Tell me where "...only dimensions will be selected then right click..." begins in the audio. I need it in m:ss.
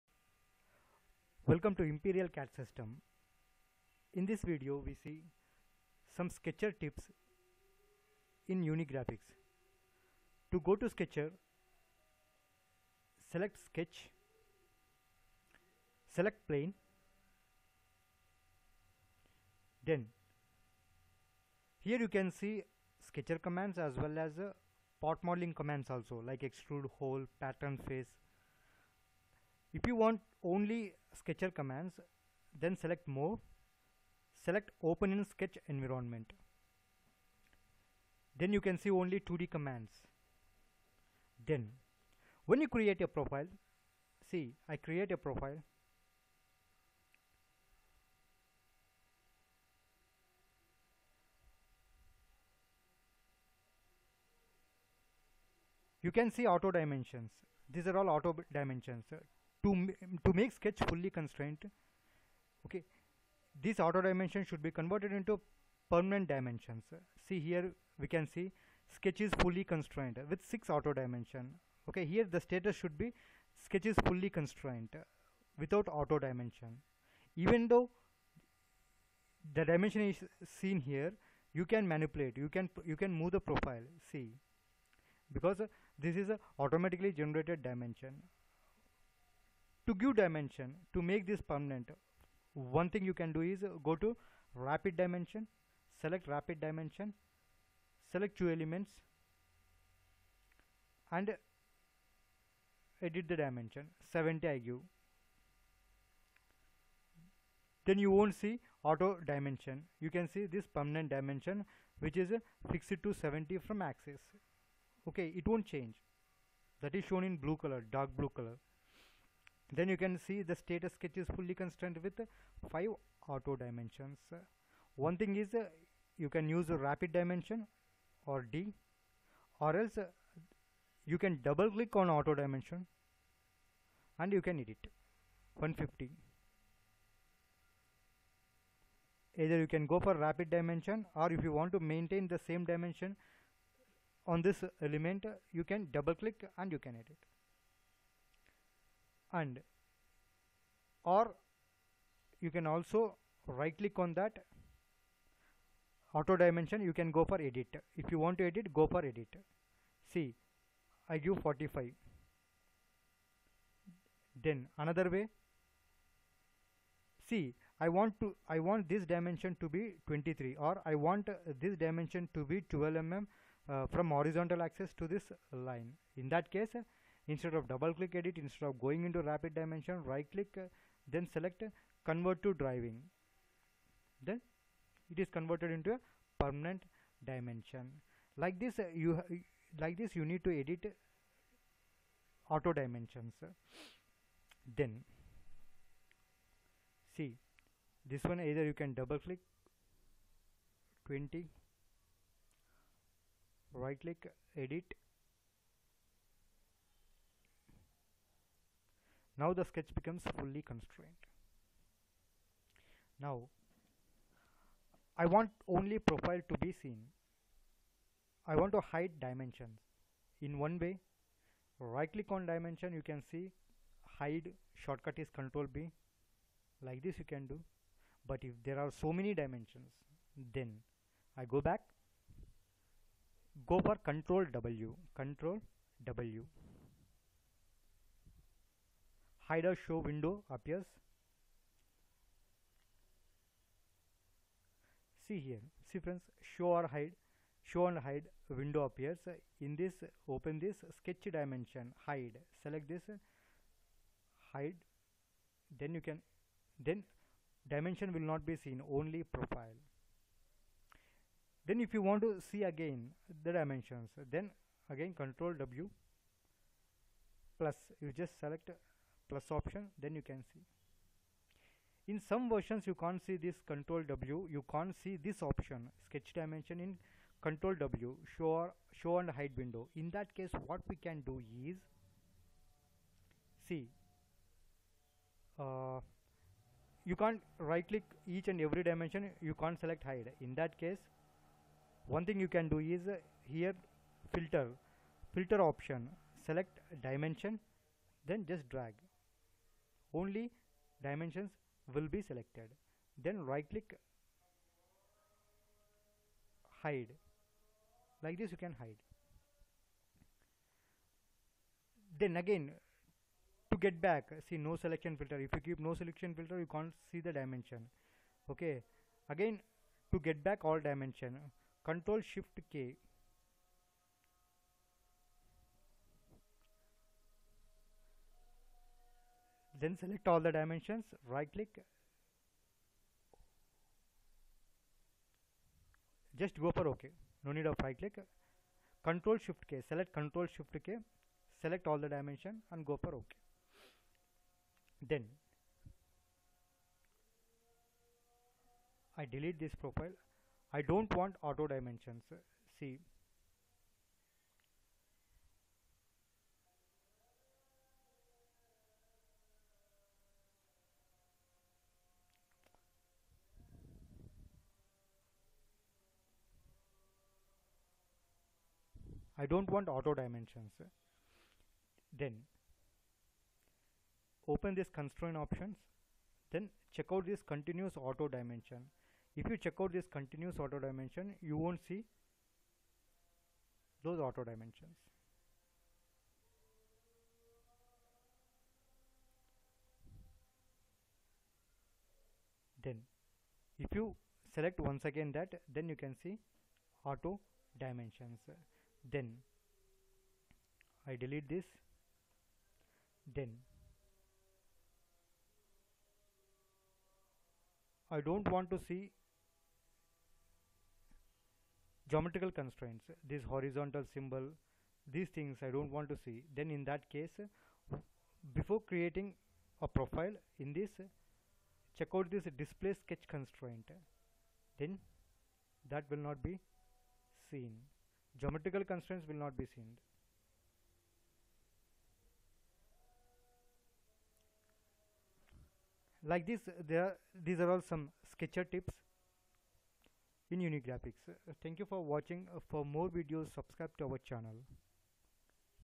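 5:00.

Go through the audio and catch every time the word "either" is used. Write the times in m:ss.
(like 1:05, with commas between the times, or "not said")
2:19, 3:18.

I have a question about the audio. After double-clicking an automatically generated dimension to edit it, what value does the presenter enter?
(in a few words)
150.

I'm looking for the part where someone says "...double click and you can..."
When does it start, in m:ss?
2:25.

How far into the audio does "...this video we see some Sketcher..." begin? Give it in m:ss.
0:04.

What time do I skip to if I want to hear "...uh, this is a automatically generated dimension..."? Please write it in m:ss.
1:25.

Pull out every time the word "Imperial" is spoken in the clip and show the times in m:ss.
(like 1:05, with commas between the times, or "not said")
0:01.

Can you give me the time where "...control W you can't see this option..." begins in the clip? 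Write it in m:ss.
4:33.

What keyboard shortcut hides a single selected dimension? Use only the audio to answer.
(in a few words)
Control B.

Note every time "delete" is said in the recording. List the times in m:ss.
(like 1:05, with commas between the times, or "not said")
5:49, 6:41.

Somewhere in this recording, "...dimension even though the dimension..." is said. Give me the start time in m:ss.
1:16.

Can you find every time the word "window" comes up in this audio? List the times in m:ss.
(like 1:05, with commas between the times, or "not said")
3:59, 4:08, 4:39.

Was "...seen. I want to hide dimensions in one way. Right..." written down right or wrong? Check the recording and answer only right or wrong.
right.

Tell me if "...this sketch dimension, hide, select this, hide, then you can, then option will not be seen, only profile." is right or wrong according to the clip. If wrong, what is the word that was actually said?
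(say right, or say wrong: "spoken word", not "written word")
wrong: "dimension", not "option".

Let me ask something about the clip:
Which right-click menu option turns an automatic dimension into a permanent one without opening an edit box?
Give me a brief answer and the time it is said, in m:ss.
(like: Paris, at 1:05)
convert to driving, at 3:02.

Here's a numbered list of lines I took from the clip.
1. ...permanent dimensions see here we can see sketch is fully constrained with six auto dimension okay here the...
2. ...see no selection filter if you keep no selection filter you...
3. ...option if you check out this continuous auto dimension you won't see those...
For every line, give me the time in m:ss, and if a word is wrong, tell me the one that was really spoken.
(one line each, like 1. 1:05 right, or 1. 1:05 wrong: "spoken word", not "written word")
1. 1:05 right
2. 5:14 right
3. 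6:18 wrong: "dimension", not "option".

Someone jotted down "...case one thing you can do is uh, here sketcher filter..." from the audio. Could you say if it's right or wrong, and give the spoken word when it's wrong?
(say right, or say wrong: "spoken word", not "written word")
wrong: "filter", not "sketcher".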